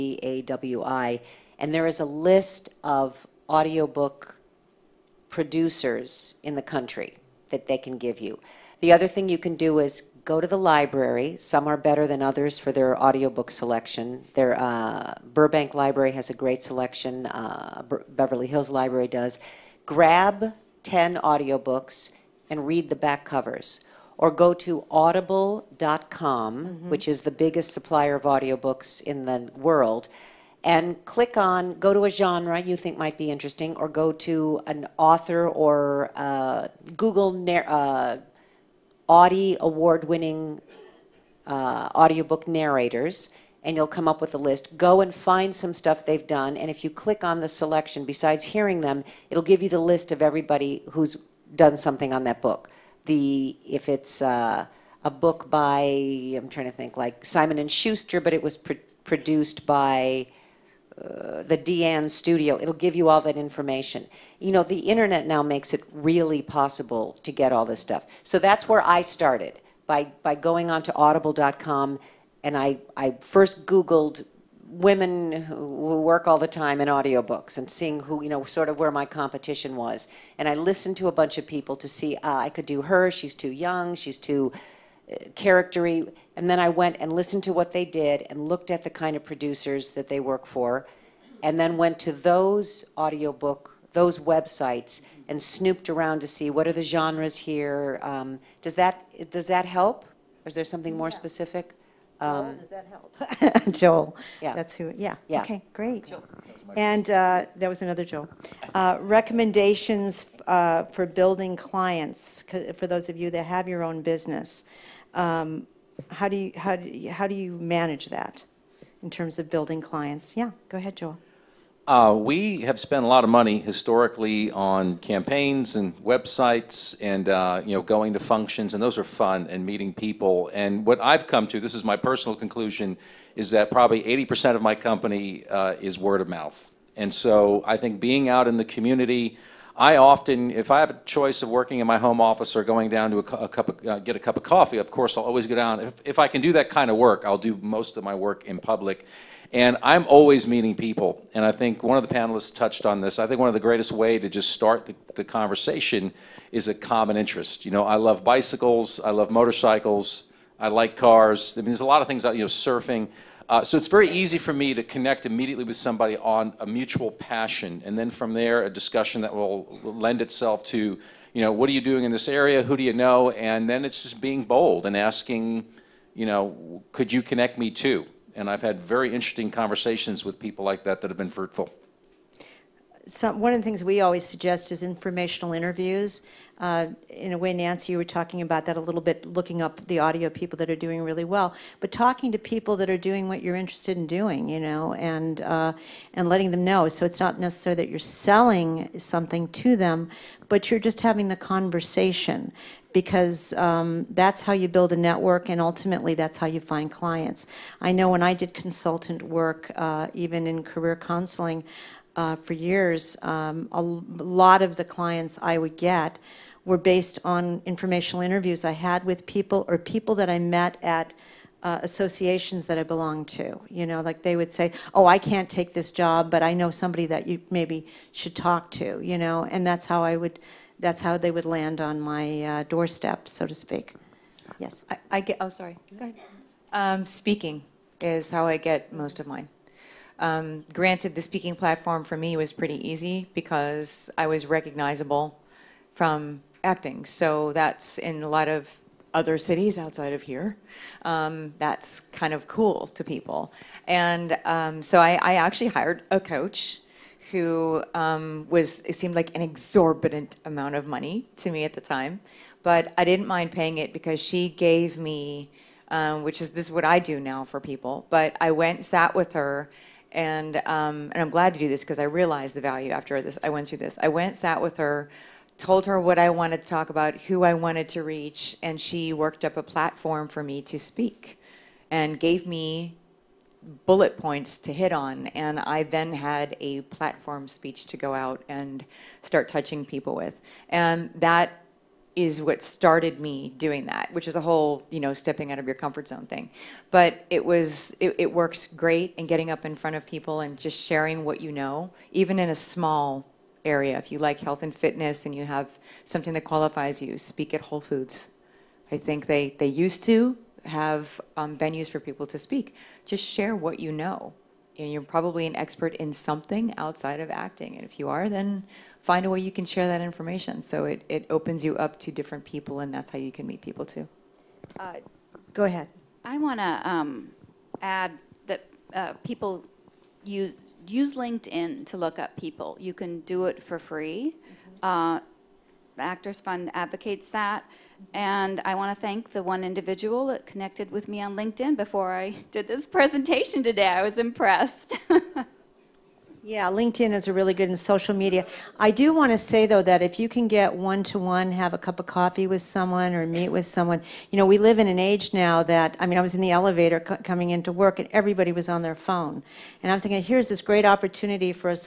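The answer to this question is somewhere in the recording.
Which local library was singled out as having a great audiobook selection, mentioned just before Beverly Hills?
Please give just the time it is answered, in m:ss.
0:15.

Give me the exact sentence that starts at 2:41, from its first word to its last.
I mean, there's a lot of things out, you know, surfing.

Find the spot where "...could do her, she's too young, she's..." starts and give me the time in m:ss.
1:22.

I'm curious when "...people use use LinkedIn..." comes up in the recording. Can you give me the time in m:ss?
5:29.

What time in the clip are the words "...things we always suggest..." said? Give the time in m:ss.
3:03.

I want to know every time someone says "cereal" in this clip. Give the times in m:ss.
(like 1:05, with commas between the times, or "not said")
not said.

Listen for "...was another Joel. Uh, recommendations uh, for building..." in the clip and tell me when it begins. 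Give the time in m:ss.
1:47.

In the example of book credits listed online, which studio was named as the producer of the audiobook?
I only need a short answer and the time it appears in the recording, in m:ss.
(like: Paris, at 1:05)
Deyan Studio, at 1:01.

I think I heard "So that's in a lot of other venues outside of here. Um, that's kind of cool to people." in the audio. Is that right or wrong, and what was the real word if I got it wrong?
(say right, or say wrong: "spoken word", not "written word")
wrong: "cities", not "venues".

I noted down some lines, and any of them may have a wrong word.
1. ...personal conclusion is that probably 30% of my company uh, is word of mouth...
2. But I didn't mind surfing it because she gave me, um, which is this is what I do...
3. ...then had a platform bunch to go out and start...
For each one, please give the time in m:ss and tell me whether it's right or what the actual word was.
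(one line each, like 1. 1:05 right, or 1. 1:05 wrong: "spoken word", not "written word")
1. 2:11 wrong: "80", not "30"
2. 4:22 wrong: "paying", not "surfing"
3. 4:45 wrong: "speech", not "bunch".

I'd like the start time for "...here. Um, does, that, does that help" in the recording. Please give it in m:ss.
1:37.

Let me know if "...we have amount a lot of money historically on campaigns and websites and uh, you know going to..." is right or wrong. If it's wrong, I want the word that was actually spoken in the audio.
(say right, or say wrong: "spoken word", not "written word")
wrong: "spent", not "amount".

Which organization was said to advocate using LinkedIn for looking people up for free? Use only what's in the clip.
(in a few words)
the Actors Fund.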